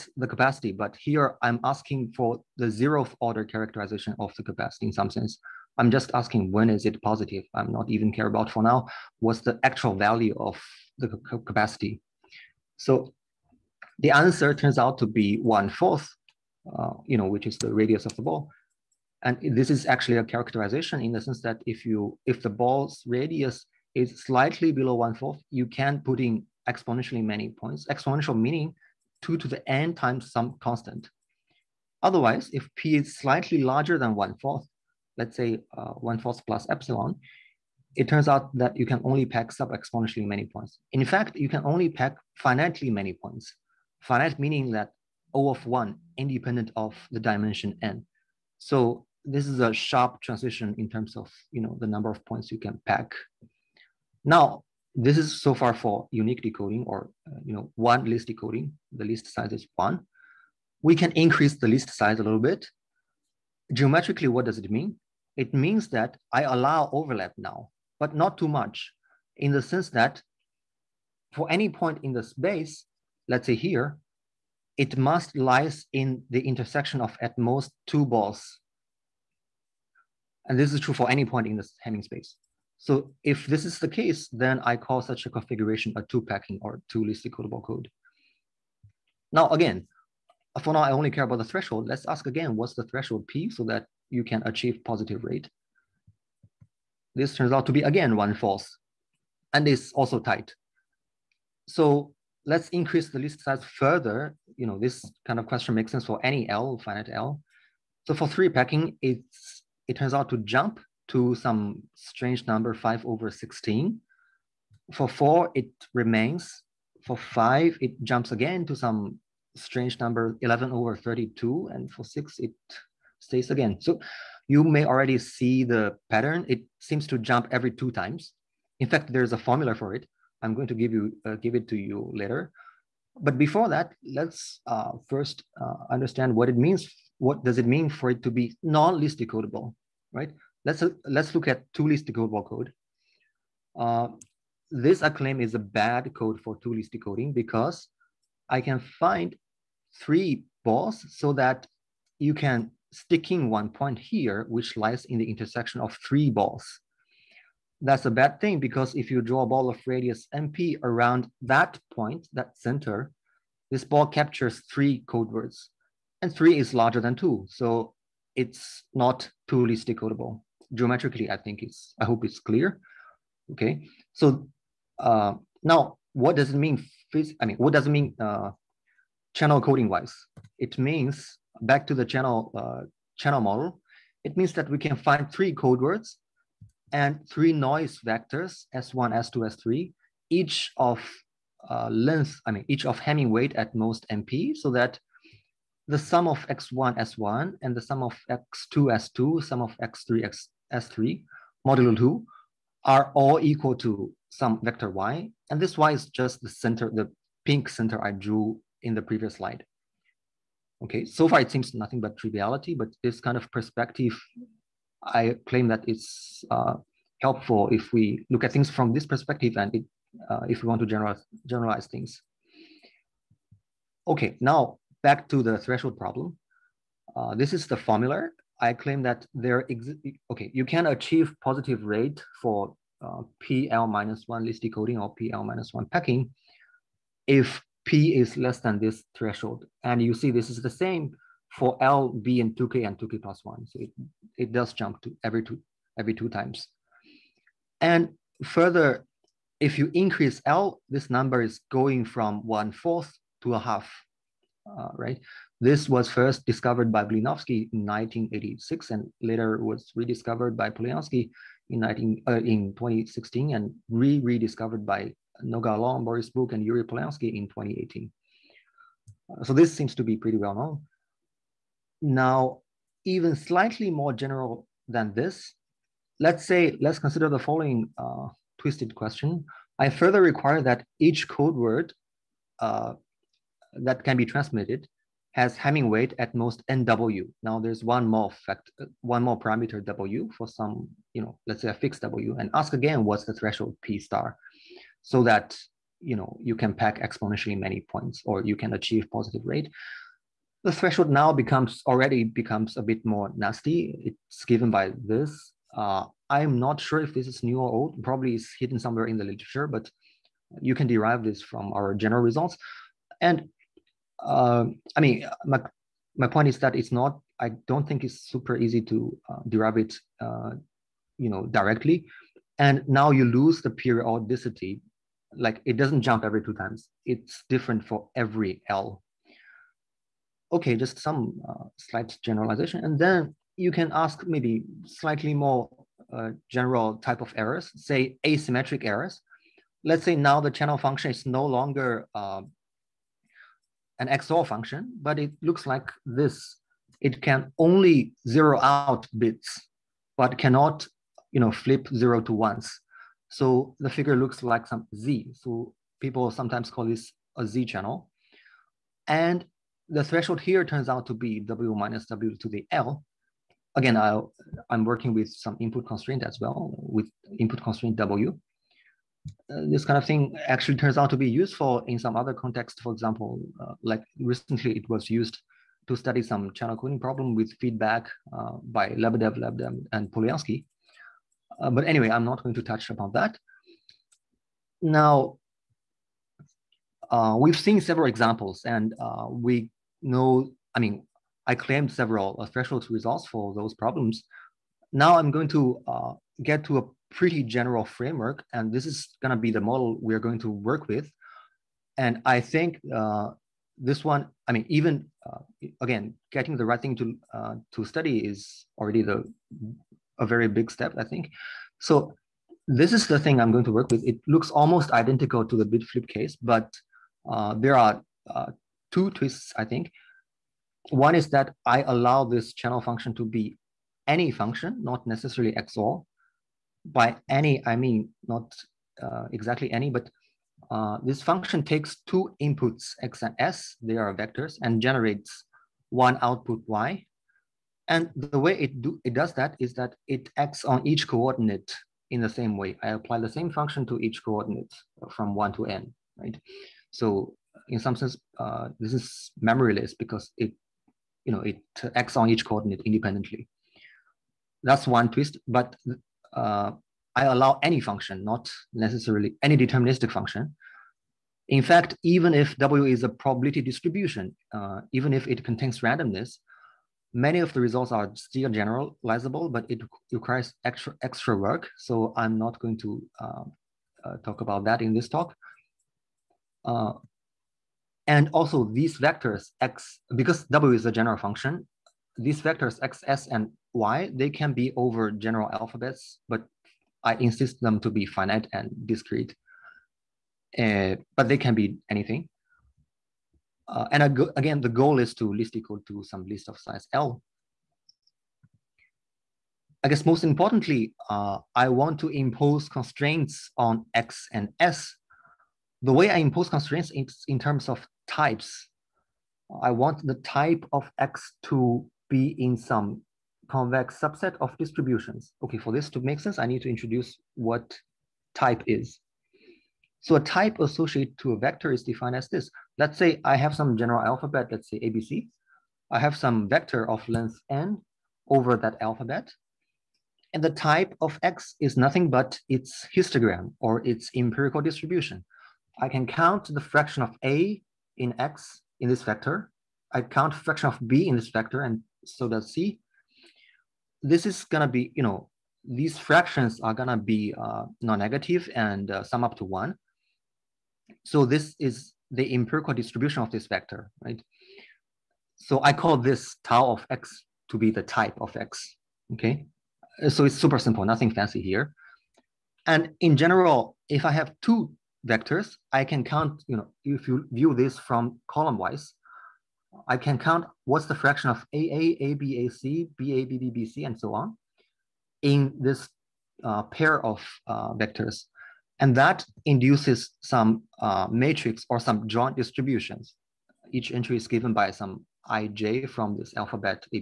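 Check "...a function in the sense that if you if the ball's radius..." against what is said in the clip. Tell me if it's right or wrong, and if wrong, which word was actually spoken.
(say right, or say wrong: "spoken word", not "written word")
wrong: "characterization", not "function".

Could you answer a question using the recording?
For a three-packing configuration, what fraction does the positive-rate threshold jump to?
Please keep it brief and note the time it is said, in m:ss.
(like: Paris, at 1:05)
5/16, at 1:52.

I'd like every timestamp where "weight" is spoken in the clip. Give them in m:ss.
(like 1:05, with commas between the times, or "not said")
3:13, 4:45.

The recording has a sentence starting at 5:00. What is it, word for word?
The threshold now becomes already becomes a bit more nasty.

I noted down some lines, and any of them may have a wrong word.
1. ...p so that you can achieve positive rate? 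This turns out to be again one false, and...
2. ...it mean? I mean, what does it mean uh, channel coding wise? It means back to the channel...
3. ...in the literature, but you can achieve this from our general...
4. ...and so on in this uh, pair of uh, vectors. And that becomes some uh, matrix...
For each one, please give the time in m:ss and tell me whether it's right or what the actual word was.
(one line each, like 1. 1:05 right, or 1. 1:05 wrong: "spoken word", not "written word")
1. 1:33 right
2. 2:56 right
3. 5:09 wrong: "derive", not "achieve"
4. 9:33 wrong: "induces", not "becomes".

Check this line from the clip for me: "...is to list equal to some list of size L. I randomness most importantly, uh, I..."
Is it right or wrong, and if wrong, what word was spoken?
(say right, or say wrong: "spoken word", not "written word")
wrong: "guess", not "randomness".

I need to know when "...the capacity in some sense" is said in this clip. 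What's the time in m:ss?
0:04.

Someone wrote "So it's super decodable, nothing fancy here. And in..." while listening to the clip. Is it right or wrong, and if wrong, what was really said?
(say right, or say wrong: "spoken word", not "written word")
wrong: "simple", not "decodable".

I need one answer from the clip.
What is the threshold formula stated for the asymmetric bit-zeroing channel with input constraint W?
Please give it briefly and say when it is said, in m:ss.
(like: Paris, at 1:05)
W minus W to the L, at 6:01.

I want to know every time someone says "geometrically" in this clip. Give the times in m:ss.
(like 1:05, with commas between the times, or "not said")
1:03, 2:50.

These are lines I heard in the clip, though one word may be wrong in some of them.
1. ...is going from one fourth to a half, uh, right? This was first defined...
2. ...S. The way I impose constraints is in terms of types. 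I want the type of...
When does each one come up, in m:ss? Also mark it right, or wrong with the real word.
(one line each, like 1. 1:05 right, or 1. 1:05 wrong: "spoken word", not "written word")
1. 4:11 wrong: "discovered", not "defined"
2. 8:24 right.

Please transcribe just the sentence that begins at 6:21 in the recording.
Uh, but anyway, I'm not going to touch upon that.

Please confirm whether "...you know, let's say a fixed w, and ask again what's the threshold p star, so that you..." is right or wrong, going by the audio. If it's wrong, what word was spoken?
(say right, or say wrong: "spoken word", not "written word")
right.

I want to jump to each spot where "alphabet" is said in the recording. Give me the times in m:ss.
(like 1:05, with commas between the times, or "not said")
8:05, 8:44, 8:48, 9:46.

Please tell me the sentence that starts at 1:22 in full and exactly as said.
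So if this is the case, then I call such a configuration a two-packing or two list decodable code.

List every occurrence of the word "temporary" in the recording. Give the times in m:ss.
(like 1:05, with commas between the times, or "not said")
not said.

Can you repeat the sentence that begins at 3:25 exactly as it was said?
And this y is just the center, the pink center I drew in the previous slide.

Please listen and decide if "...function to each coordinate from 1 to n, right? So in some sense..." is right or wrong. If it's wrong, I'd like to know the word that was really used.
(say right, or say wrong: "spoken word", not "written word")
right.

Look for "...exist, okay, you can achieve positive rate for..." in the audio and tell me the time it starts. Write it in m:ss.
3:49.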